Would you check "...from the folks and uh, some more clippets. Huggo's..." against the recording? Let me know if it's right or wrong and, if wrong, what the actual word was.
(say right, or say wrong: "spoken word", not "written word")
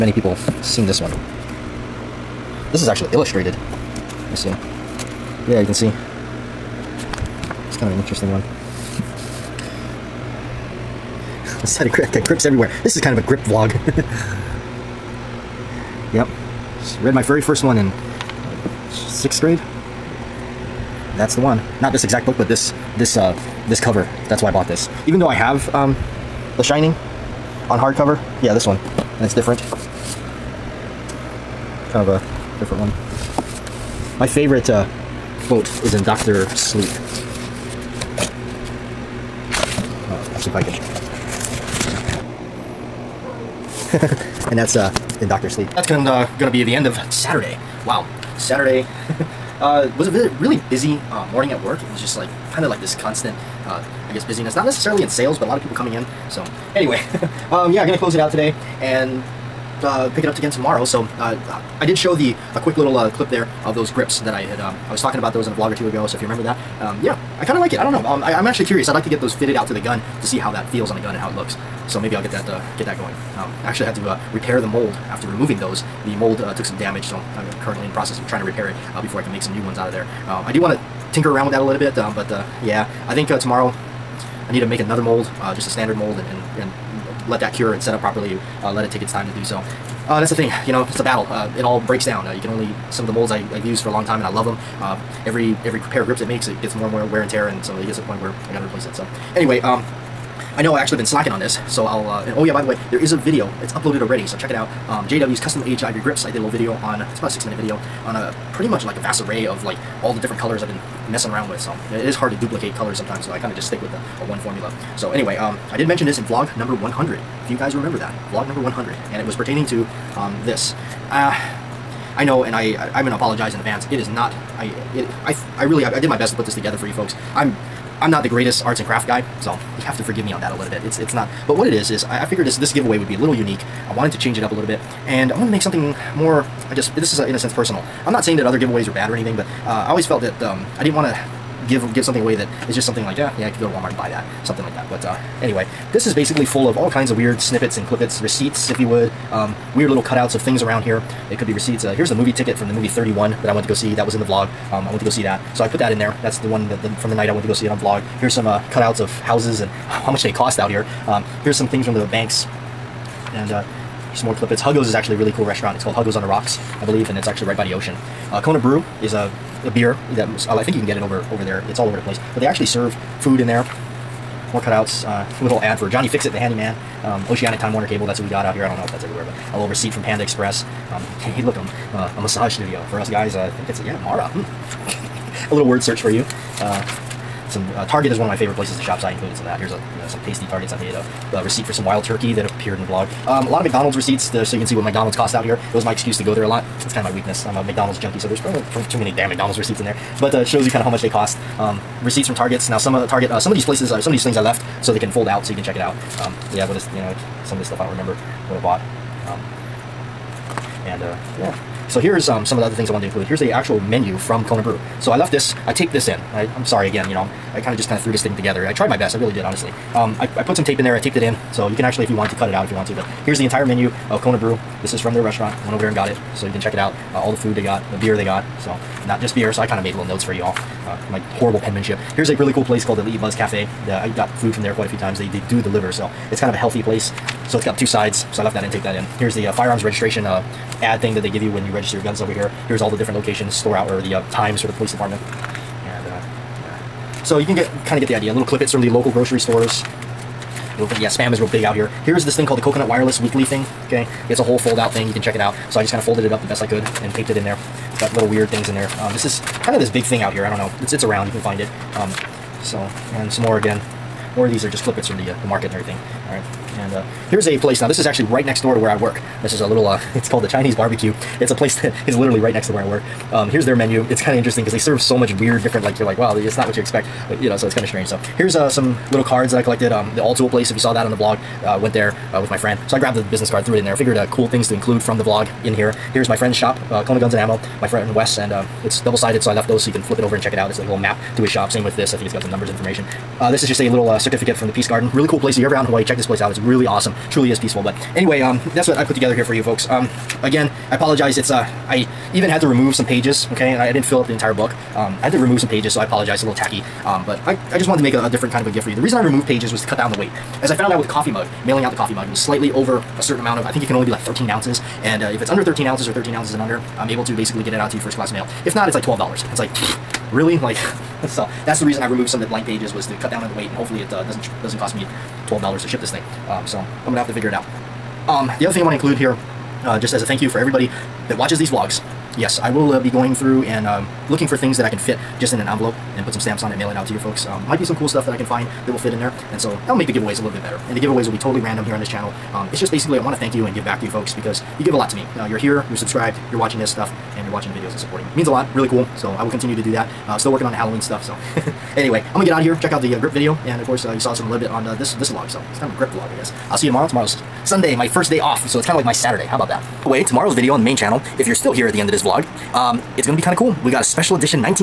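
wrong: "banks", not "folks".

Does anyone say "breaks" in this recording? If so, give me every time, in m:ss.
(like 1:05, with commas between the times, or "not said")
1:31.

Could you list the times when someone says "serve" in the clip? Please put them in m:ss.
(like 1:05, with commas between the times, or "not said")
2:52, 4:34.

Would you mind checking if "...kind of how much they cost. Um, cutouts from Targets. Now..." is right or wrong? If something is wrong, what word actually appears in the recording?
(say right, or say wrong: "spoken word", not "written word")
wrong: "receipts", not "cutouts".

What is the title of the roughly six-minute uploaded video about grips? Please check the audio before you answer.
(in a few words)
JW's custom age ivory grips.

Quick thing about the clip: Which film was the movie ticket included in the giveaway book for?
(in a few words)
31.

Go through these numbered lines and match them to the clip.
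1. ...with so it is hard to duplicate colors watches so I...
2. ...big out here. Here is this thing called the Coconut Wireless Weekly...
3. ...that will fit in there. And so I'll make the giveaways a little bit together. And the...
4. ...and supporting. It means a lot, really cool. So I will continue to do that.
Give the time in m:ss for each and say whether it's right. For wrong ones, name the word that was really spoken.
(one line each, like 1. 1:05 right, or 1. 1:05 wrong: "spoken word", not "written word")
1. 1:51 wrong: "sometimes", not "watches"
2. 4:11 right
3. 5:38 wrong: "better", not "together"
4. 5:47 right.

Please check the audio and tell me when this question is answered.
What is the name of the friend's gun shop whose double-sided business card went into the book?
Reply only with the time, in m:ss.
4:47.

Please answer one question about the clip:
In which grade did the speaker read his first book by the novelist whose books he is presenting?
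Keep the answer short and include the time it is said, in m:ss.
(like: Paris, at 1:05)
sixth grade, at 0:19.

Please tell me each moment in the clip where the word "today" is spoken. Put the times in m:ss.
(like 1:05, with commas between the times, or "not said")
0:58.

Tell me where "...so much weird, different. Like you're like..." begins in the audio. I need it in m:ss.
4:34.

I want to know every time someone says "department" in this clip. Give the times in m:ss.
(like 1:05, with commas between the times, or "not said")
4:04.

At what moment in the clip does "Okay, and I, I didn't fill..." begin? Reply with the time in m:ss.
5:03.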